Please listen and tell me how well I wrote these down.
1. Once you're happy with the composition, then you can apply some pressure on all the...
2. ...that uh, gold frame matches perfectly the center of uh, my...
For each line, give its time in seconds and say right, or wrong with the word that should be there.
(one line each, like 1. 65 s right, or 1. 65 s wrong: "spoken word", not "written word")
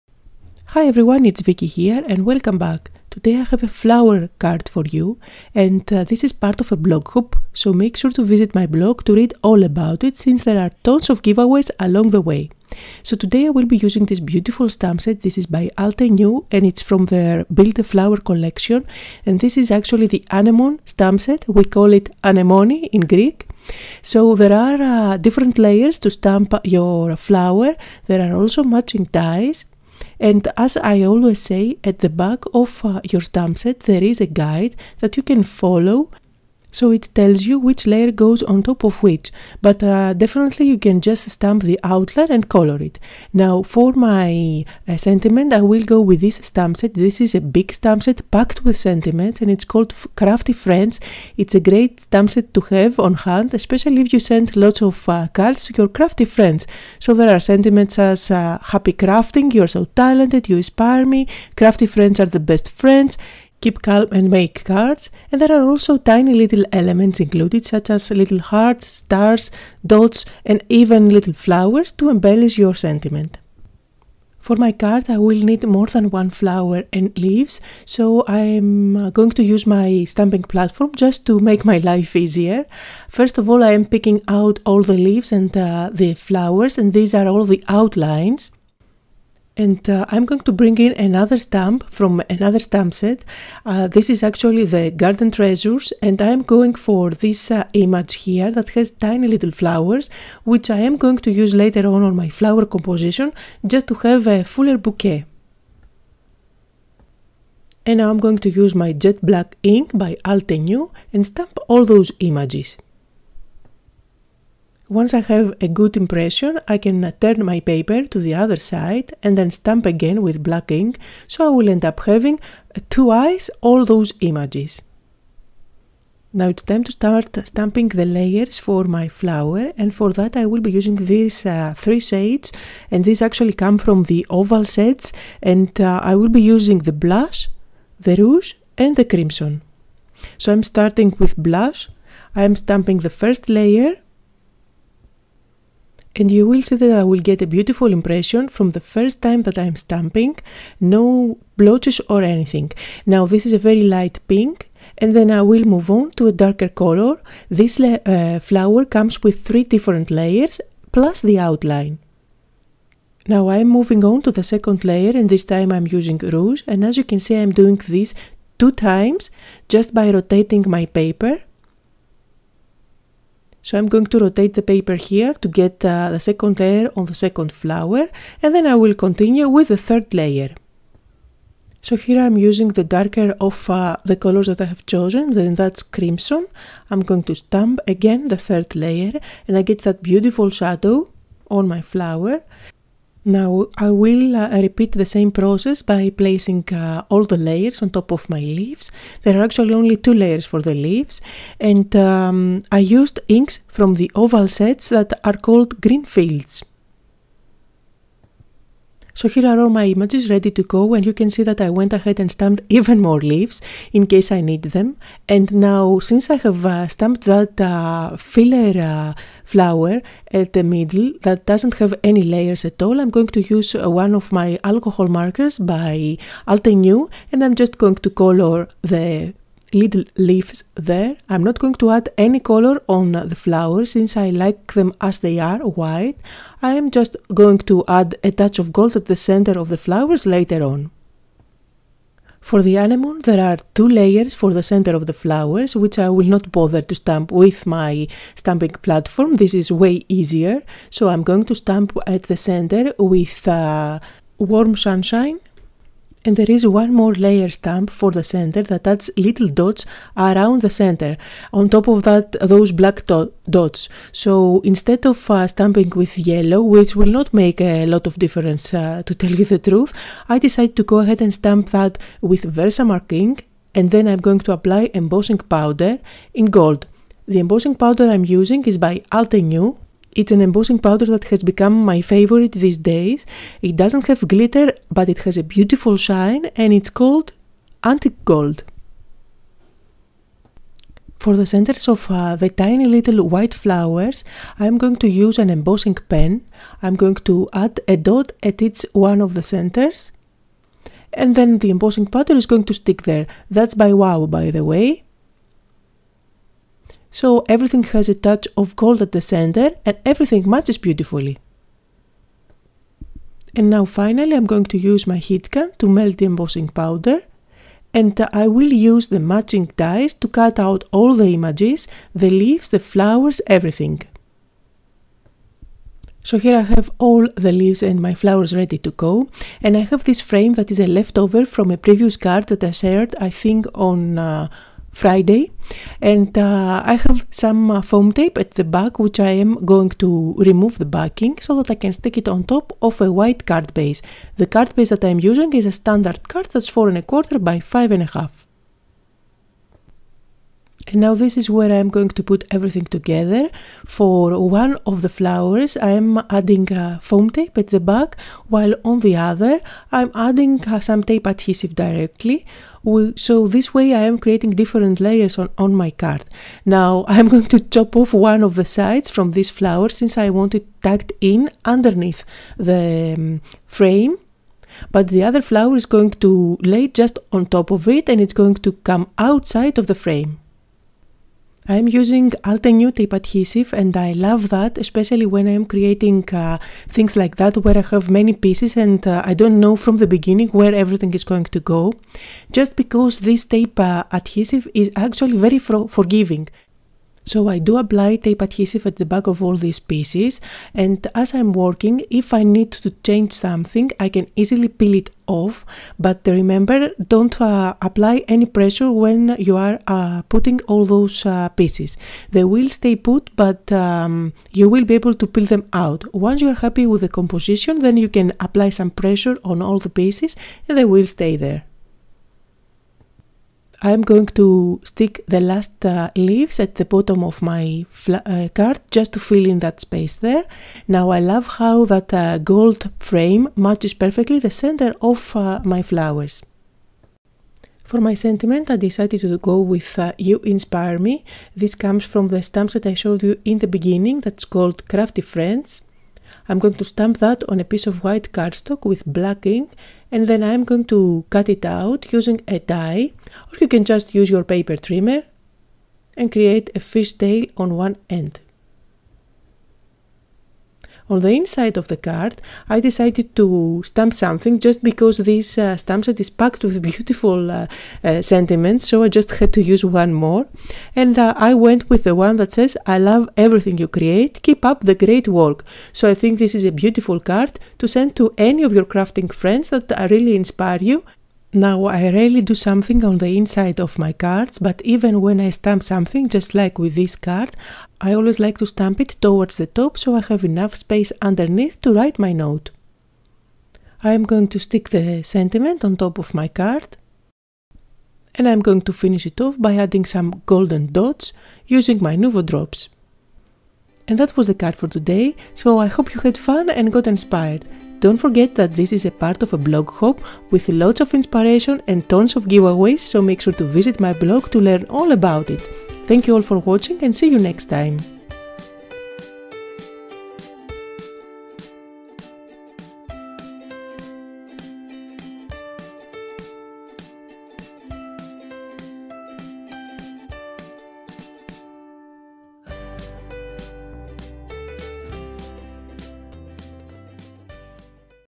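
1. 416 s right
2. 431 s right.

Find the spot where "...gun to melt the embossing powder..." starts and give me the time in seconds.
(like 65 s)
315 s.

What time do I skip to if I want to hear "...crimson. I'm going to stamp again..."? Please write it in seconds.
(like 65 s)
185 s.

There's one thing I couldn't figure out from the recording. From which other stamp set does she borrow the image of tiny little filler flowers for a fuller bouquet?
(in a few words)
Garden Treasures.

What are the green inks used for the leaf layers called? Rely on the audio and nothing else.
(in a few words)
Green Fields.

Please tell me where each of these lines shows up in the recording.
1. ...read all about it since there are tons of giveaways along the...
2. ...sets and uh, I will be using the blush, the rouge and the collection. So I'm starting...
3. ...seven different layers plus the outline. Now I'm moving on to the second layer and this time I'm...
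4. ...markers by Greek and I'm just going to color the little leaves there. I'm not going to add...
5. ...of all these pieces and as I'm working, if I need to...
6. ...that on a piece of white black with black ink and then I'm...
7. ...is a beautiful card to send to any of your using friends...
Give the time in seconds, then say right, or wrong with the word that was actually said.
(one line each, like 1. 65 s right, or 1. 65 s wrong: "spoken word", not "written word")
1. 9 s right
2. 134 s wrong: "crimson", not "collection"
3. 159 s wrong: "three", not "seven"
4. 225 s wrong: "Altenew", not "Greek"
5. 399 s right
6. 447 s wrong: "cardstock", not "black"
7. 476 s wrong: "crafting", not "using".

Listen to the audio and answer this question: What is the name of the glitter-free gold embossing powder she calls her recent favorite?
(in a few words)
Antique Gold.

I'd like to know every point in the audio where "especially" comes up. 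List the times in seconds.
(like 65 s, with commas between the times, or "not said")
53 s, 384 s.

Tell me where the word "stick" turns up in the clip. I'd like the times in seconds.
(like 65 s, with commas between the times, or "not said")
302 s, 341 s, 424 s, 494 s.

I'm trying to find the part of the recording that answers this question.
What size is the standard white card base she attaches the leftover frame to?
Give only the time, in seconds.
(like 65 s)
346 s.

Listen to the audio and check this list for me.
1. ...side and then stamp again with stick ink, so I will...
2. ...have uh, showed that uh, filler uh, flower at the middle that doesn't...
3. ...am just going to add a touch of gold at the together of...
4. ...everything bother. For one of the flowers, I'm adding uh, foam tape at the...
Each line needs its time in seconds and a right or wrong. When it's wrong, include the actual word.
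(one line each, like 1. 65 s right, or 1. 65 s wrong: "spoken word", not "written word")
1. 118 s wrong: "black", not "stick"
2. 216 s wrong: "stamped", not "showed"
3. 236 s wrong: "center", not "together"
4. 352 s wrong: "together", not "bother".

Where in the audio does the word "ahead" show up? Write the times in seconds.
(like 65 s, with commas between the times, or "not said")
211 s, 270 s.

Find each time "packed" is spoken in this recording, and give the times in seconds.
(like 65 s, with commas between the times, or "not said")
48 s, 466 s.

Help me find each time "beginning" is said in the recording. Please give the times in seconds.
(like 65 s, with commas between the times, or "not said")
390 s, 443 s.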